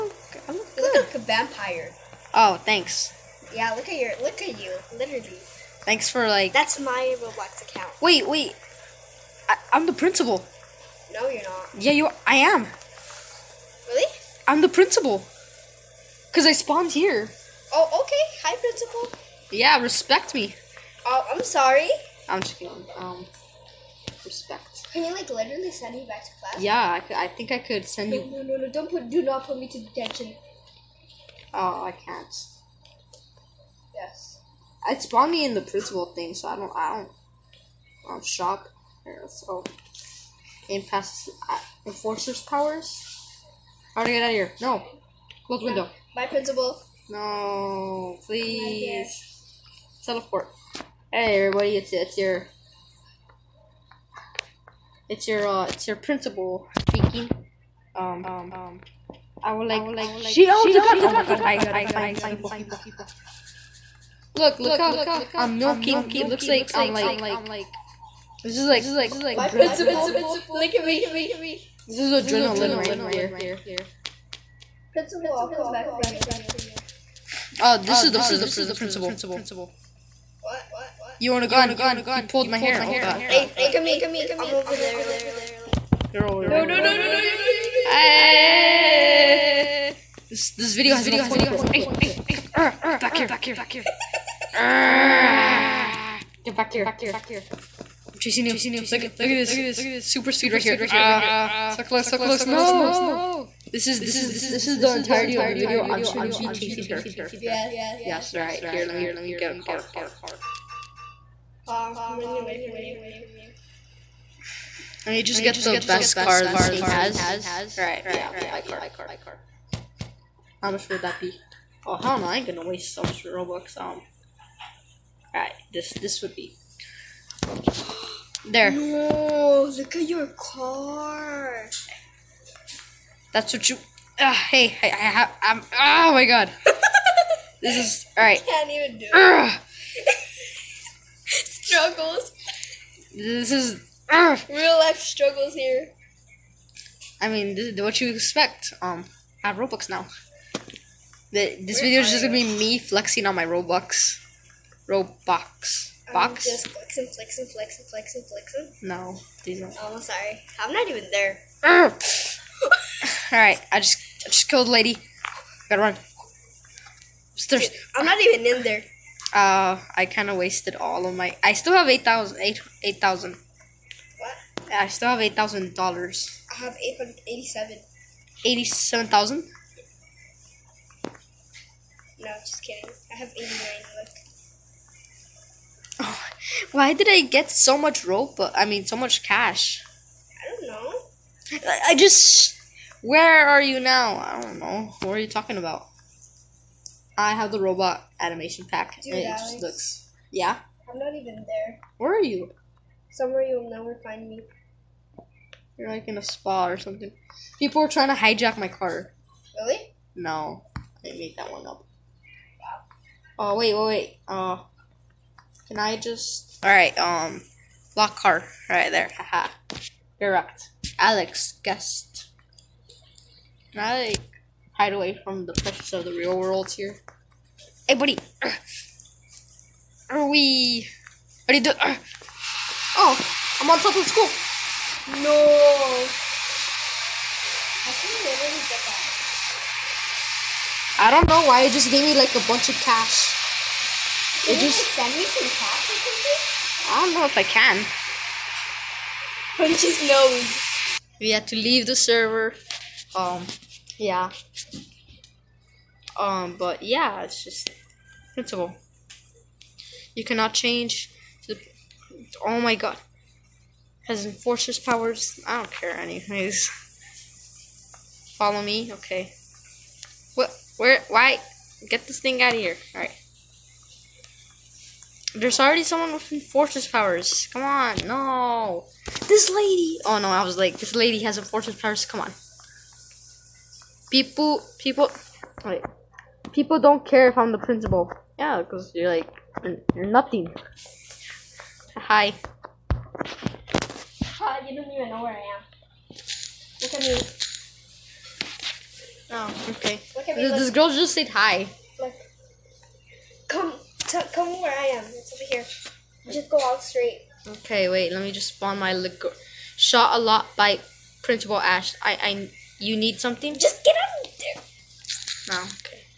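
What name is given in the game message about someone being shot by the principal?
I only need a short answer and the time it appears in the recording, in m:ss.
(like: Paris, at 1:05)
Principal Ash, at 5:11.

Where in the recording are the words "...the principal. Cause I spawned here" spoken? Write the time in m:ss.
0:14.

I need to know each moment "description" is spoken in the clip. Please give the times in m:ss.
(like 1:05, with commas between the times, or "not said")
not said.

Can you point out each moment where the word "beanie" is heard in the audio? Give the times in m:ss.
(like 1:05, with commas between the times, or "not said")
not said.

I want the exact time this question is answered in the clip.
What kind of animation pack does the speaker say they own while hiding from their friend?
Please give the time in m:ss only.
3:17.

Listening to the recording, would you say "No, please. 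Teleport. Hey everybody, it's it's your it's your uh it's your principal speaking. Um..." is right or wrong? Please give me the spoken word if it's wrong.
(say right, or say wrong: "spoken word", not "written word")
right.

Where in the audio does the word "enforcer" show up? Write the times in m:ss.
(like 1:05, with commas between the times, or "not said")
0:41, 4:24.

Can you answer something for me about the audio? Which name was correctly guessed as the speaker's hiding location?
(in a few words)
Lockhart.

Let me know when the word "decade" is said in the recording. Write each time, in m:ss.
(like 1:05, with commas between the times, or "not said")
not said.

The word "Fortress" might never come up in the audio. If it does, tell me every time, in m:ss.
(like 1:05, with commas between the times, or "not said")
4:36, 4:41.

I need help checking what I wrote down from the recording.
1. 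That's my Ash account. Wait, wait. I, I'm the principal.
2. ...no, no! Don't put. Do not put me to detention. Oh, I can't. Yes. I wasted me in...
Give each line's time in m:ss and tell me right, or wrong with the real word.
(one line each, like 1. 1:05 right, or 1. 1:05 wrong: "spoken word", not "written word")
1. 0:06 wrong: "Roblox", not "Ash"
2. 0:28 wrong: "spawned", not "wasted".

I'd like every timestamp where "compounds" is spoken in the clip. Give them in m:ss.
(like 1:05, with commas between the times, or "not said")
not said.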